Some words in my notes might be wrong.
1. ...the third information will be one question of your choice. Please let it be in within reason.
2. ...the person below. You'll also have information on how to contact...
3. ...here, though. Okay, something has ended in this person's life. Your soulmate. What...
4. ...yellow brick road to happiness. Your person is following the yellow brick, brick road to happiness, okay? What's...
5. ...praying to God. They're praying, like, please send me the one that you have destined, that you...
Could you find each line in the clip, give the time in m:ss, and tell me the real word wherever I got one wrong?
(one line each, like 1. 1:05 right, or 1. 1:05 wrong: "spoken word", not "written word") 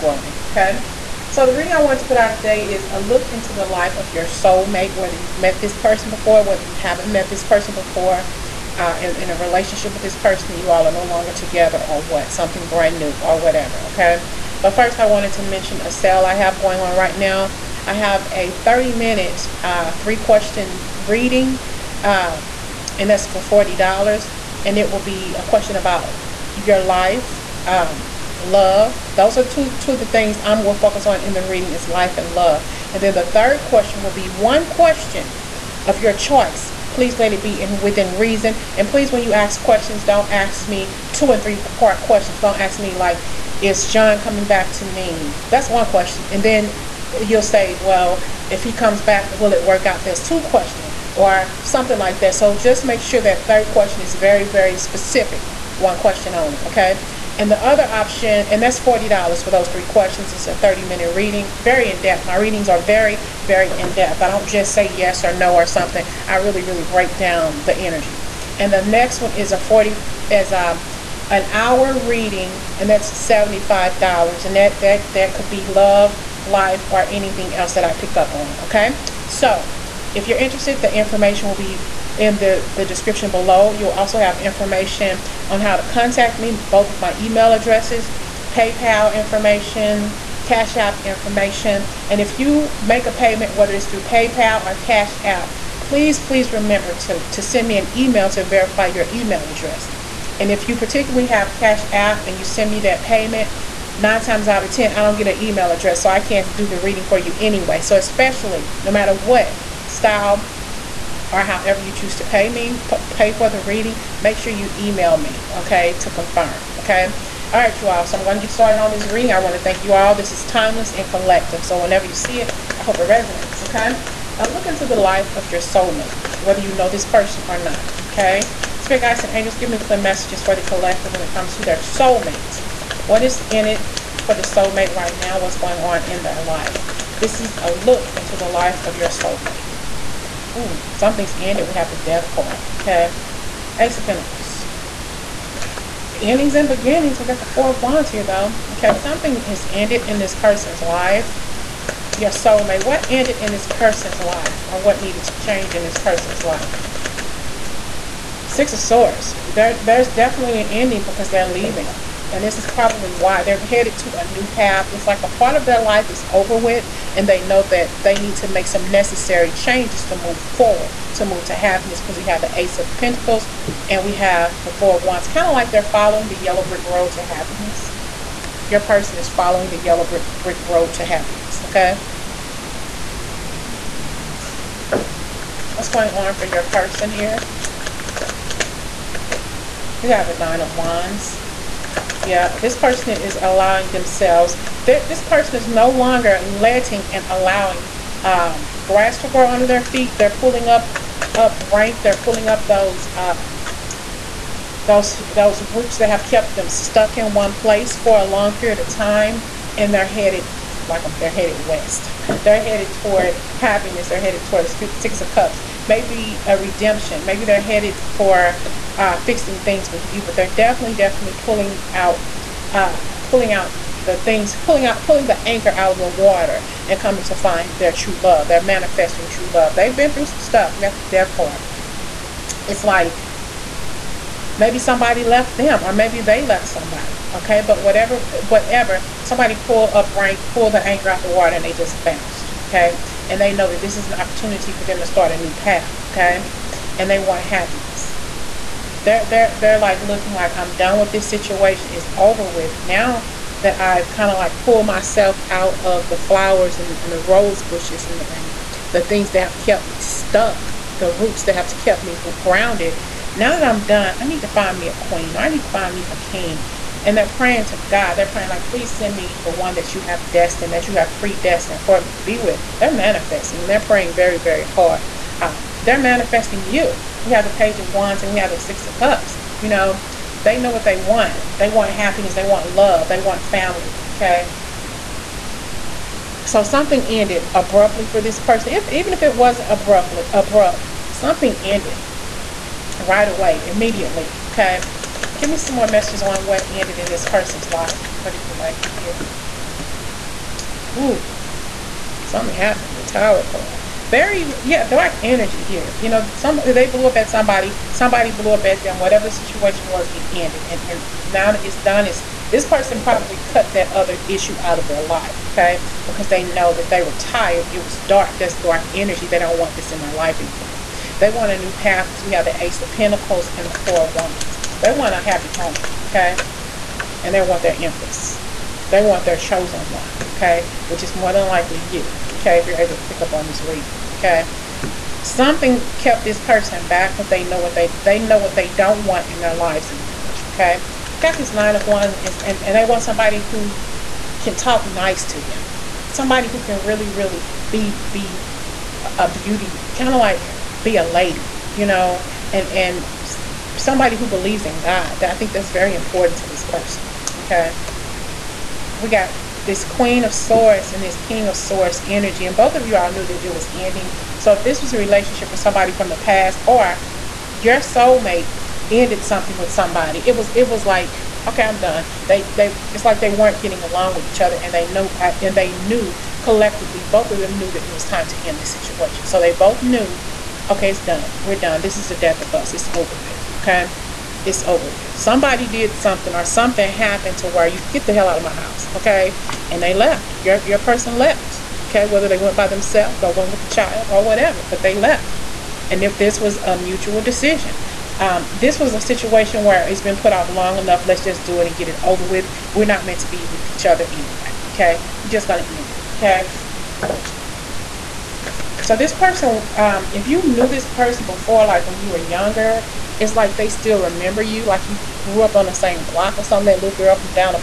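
1. 0:33 wrong: "question", not "information"
2. 1:22 wrong: "description", not "person"
3. 2:28 right
4. 2:56 right
5. 4:27 right.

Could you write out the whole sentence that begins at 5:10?
And and now that it's done, it's this person probably cut that other issue out of their life.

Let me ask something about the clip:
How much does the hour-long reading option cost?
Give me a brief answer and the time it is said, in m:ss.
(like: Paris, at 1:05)
$75, at 1:13.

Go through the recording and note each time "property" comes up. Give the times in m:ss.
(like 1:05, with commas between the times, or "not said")
not said.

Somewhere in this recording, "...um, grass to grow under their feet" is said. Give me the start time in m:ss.
3:18.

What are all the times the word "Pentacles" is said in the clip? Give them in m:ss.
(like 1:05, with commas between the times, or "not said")
2:24, 2:52, 5:22.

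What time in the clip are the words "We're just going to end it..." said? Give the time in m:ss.
6:45.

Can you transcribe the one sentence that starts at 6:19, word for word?
So they both knew, okay, it's done.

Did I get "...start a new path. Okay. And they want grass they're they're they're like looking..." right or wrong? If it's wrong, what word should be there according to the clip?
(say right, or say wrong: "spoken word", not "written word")
wrong: "happiness", not "grass".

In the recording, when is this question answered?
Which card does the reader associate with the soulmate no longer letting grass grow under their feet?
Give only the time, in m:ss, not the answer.
3:10.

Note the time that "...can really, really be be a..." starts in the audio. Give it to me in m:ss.
5:46.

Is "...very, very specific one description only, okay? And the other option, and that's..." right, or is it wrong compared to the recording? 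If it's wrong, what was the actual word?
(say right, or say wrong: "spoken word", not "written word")
wrong: "question", not "description".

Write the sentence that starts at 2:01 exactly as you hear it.
So whenever you see it, I hope it resonates, okay?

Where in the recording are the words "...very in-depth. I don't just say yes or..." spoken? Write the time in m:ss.
1:03.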